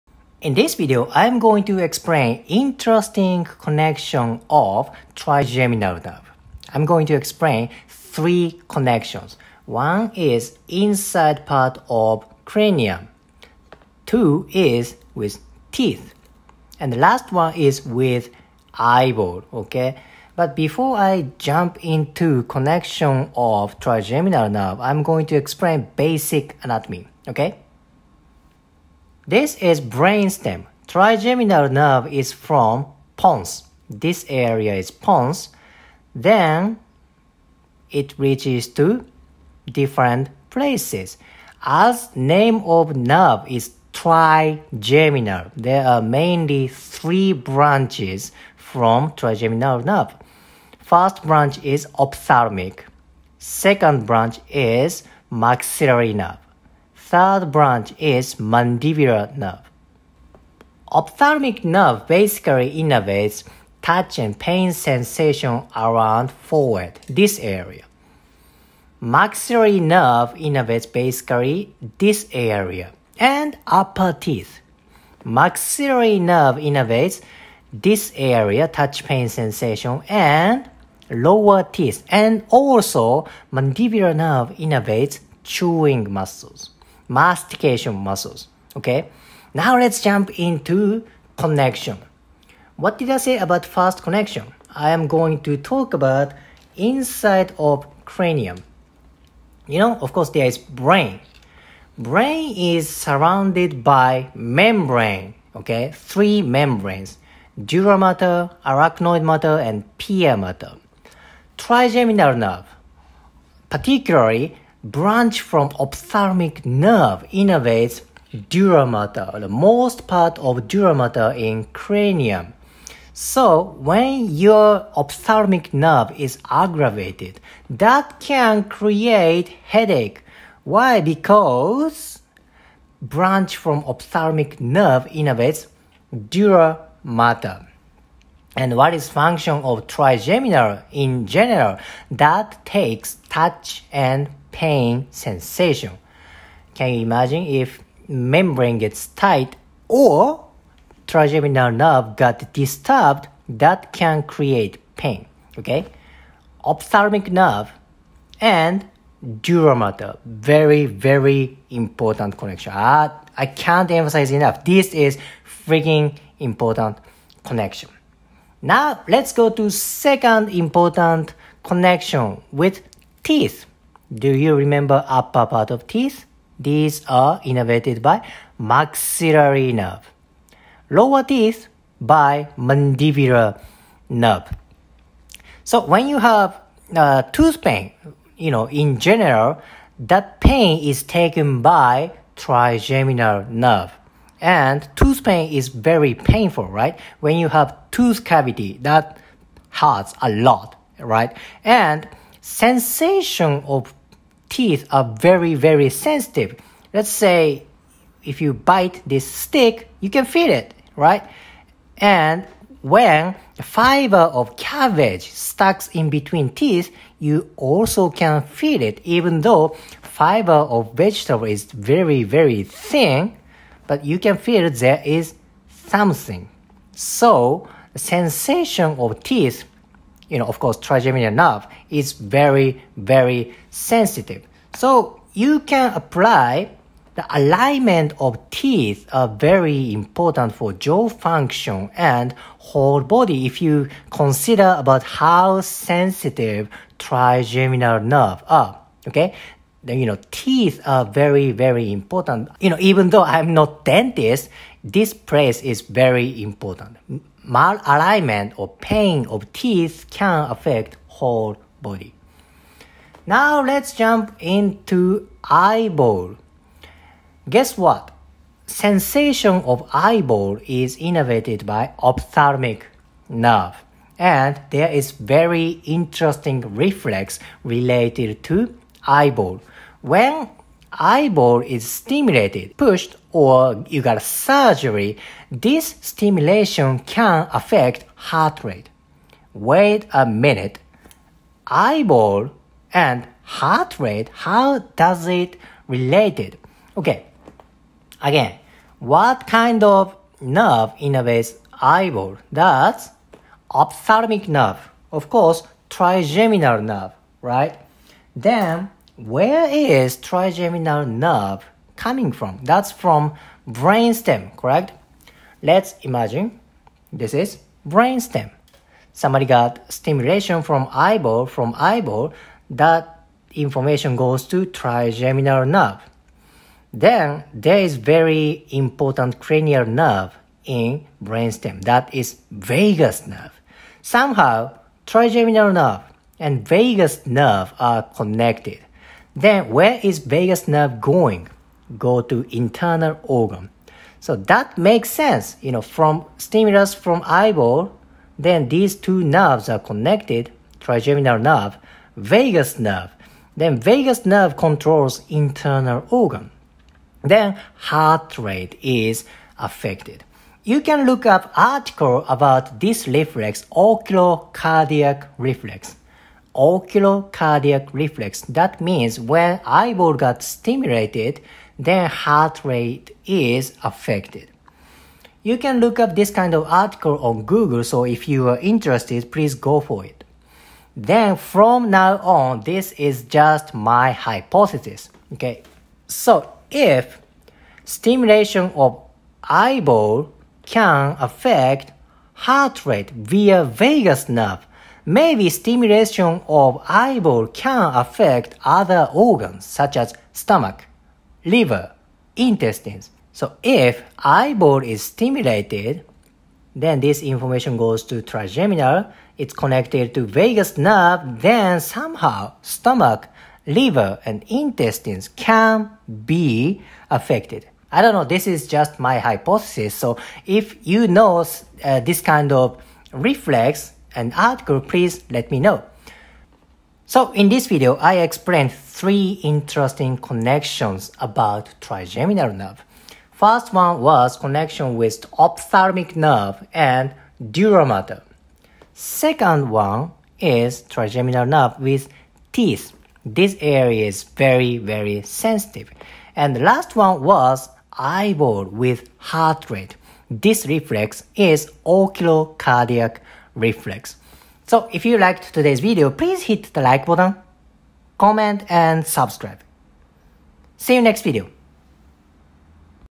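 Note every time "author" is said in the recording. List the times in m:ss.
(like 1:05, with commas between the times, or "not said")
not said.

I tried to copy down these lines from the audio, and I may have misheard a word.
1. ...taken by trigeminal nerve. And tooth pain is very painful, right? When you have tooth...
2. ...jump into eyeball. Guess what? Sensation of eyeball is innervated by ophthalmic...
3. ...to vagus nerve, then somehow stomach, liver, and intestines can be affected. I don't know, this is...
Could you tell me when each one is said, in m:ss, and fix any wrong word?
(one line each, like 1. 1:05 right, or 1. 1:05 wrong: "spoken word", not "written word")
1. 3:11 right
2. 4:23 right
3. 6:50 right.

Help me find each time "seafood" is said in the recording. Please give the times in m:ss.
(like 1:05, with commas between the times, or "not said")
not said.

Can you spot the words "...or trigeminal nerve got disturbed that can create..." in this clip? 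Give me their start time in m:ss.
2:29.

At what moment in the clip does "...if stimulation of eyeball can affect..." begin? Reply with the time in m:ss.
6:26.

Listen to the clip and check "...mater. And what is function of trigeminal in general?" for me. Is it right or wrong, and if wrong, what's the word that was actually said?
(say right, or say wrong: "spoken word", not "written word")
right.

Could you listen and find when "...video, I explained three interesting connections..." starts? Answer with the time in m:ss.
7:07.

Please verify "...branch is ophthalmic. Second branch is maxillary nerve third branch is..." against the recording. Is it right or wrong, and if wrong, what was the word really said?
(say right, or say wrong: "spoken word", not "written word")
right.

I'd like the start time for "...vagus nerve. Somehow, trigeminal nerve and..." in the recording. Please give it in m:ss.
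5:32.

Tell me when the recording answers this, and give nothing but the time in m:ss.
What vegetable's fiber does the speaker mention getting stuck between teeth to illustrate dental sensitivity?
3:33.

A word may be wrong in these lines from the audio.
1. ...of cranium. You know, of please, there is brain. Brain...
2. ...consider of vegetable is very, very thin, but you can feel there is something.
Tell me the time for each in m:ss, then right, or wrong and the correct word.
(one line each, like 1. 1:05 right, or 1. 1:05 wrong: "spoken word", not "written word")
1. 1:37 wrong: "course", not "please"
2. 3:40 wrong: "fiber", not "consider".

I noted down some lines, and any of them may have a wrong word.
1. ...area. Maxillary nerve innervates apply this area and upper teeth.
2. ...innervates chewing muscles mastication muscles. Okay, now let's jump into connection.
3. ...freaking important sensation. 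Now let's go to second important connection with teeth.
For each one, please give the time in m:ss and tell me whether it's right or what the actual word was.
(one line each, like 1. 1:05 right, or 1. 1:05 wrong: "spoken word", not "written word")
1. 1:07 wrong: "basically", not "apply"
2. 1:24 right
3. 2:45 wrong: "connection", not "sensation".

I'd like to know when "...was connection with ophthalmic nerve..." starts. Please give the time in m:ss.
7:14.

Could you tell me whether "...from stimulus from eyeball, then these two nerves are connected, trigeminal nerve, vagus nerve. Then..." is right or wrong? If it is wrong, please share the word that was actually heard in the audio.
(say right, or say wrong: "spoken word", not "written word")
right.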